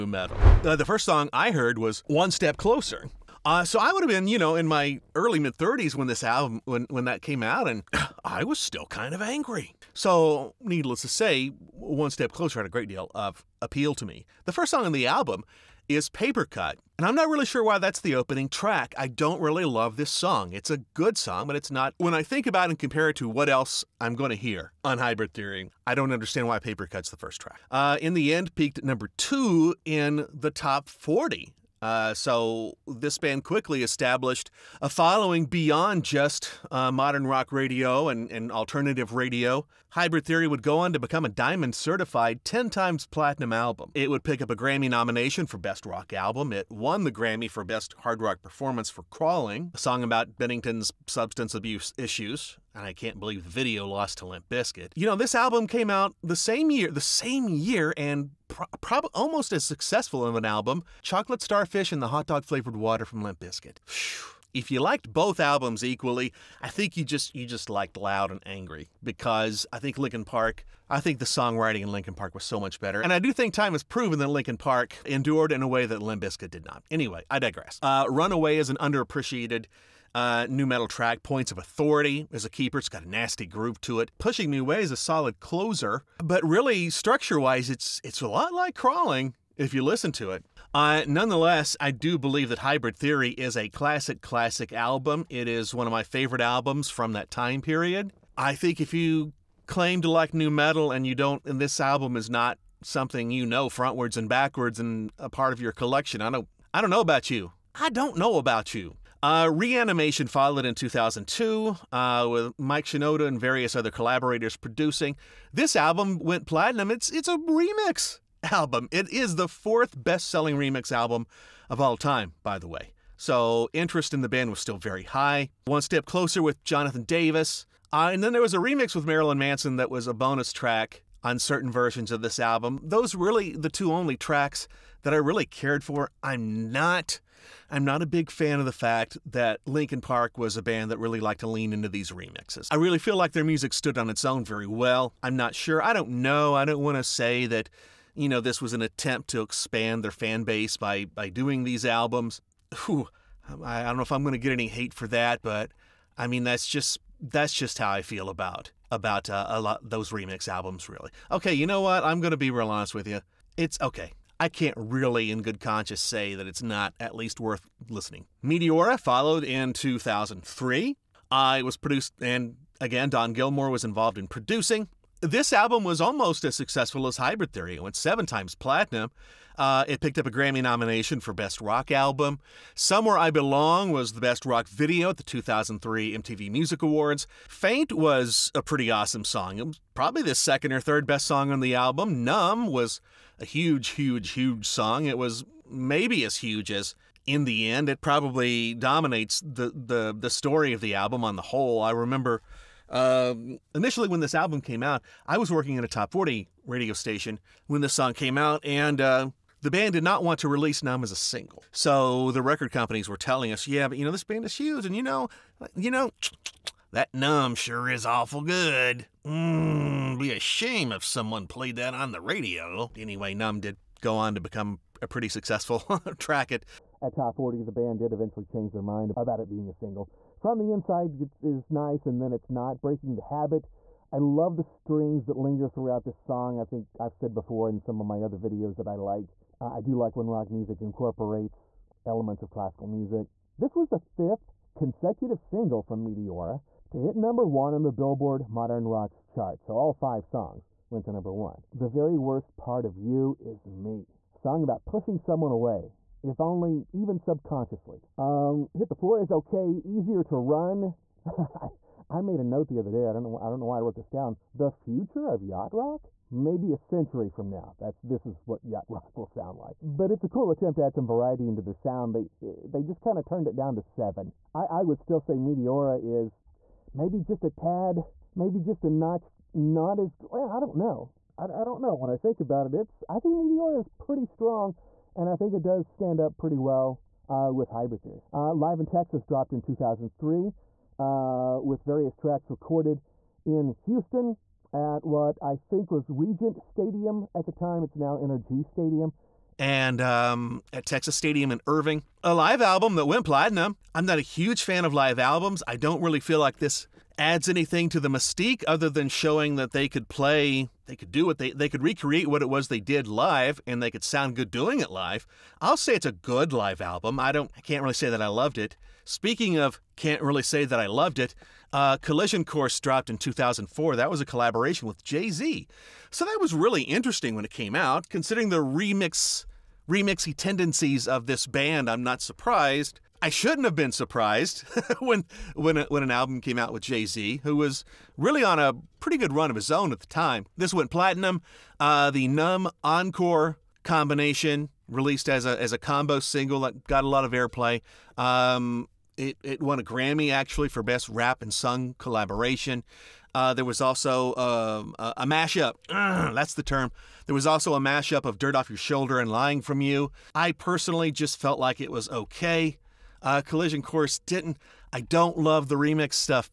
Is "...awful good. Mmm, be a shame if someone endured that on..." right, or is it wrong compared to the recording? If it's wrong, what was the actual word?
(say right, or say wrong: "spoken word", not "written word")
wrong: "played", not "endured".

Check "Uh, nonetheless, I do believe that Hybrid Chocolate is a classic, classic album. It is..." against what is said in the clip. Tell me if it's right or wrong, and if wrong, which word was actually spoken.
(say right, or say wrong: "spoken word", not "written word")
wrong: "Theory", not "Chocolate".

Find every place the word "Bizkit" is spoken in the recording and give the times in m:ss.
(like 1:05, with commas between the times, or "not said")
0:54, 1:03, 1:16.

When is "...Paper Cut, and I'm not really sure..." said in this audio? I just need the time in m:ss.
0:16.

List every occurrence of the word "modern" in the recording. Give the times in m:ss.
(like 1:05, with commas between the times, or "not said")
0:36, 4:08.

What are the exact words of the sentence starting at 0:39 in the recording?
Hybrid Theory would go on to become a Diamond certified 10 times platinum album.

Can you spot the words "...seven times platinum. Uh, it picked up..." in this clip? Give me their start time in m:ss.
2:57.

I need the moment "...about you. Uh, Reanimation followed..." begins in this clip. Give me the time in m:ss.
1:48.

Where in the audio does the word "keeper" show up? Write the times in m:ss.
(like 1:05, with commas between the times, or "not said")
1:22.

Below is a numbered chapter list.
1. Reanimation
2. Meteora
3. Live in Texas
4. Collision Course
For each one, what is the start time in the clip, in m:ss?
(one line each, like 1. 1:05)
1. 1:48
2. 2:47
3. 4:47
4. 5:20.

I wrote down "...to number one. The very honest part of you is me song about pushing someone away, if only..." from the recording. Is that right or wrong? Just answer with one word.
wrong.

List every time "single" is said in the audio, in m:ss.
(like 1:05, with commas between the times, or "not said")
3:31, 3:49, 4:05, 5:46.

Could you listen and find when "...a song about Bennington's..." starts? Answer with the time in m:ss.
0:49.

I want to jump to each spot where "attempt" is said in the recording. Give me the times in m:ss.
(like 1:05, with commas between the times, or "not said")
2:28, 4:30.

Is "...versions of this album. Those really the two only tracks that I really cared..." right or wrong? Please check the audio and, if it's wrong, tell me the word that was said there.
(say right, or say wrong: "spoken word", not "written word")
right.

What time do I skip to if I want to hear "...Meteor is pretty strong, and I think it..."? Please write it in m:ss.
4:43.